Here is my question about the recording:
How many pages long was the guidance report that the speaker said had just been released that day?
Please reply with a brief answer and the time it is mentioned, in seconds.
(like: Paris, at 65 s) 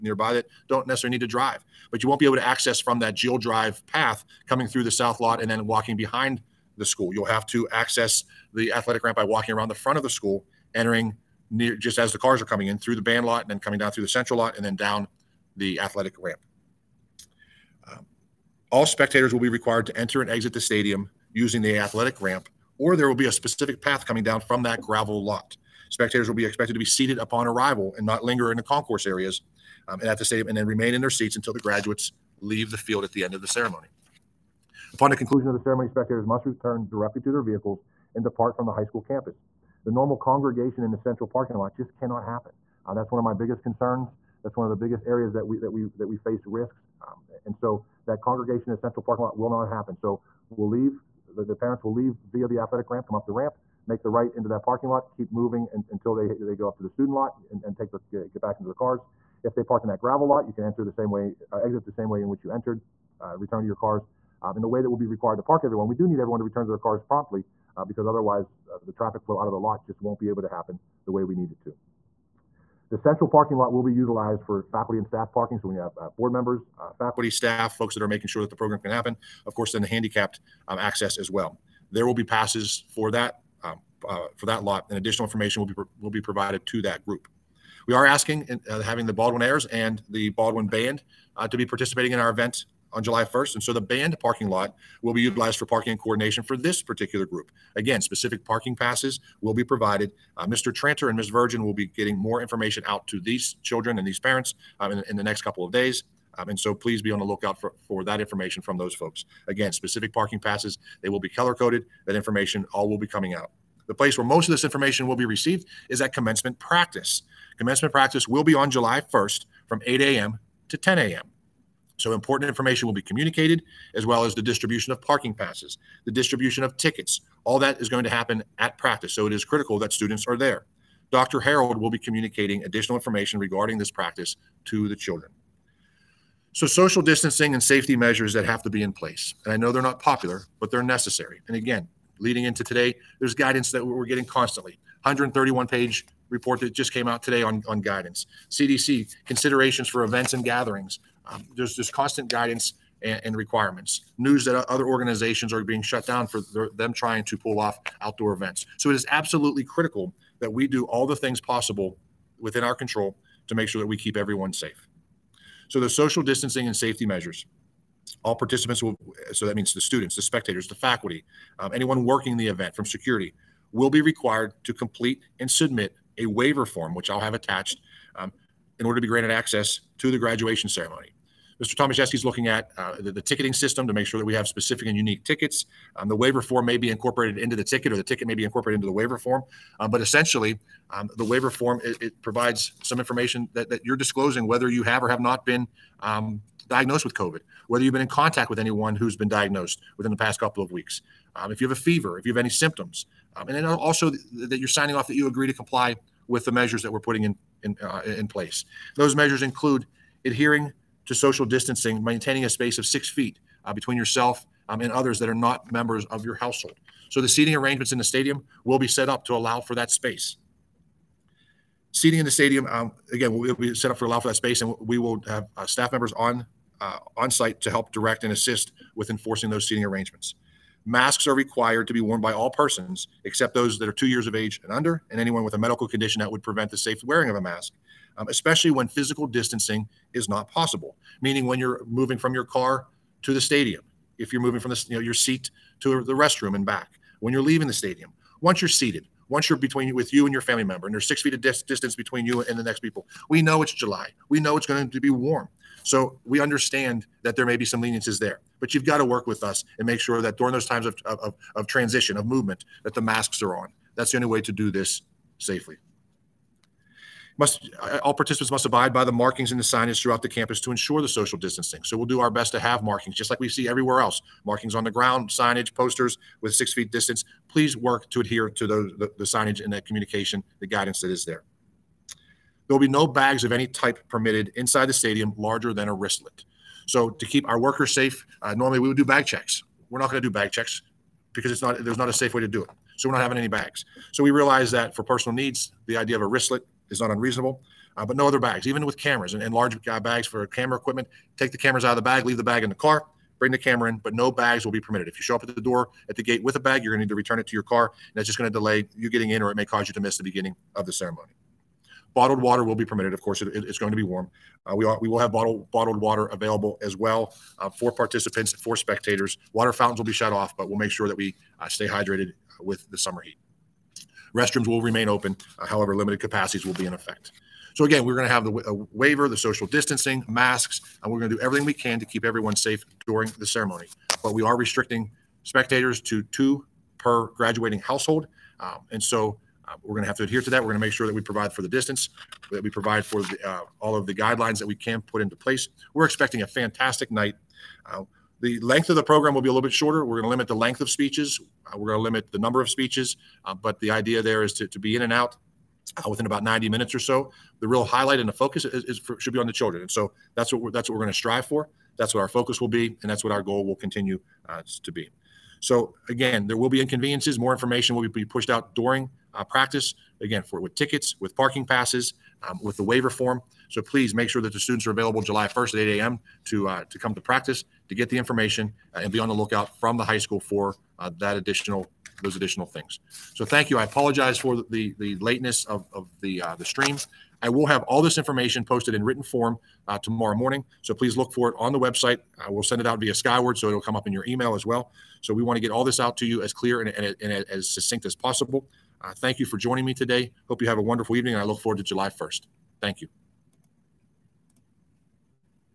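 131, at 145 s.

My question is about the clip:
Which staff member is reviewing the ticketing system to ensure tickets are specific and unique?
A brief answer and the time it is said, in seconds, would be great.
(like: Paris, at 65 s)
Mr. Tomaszewski, at 181 s.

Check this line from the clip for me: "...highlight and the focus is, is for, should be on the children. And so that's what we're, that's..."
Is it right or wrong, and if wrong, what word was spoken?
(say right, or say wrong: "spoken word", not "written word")
right.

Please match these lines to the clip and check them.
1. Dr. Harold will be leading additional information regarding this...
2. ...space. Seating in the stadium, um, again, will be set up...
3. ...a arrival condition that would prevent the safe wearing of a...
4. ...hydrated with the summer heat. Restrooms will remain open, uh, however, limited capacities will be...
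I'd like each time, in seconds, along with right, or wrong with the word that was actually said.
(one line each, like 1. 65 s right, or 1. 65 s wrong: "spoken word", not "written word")
1. 131 s wrong: "communicating", not "leading"
2. 219 s right
3. 235 s wrong: "medical", not "arrival"
4. 321 s right.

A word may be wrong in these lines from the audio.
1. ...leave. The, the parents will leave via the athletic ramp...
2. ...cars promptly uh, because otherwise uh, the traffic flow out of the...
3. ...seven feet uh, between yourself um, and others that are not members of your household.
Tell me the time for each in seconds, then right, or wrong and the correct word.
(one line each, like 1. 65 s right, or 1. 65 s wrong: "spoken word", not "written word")
1. 50 s right
2. 66 s right
3. 212 s wrong: "six", not "seven".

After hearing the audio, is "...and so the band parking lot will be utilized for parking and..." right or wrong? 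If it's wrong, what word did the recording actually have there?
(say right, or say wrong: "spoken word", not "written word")
right.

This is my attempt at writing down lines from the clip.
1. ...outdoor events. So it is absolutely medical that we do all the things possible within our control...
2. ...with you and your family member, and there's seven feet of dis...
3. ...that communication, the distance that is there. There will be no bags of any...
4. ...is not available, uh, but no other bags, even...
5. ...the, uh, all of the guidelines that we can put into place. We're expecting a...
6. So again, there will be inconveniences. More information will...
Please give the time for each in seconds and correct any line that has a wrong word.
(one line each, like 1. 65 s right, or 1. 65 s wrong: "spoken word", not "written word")
1. 157 s wrong: "critical", not "medical"
2. 249 s wrong: "six", not "seven"
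3. 279 s wrong: "guidance", not "distance"
4. 296 s wrong: "unreasonable", not "available"
5. 343 s right
6. 365 s right.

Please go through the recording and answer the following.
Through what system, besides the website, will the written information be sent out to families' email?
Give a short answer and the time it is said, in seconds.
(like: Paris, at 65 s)
Skyward, at 393 s.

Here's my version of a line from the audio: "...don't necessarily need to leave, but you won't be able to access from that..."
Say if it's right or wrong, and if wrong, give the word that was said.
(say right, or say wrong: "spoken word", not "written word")
wrong: "drive", not "leave".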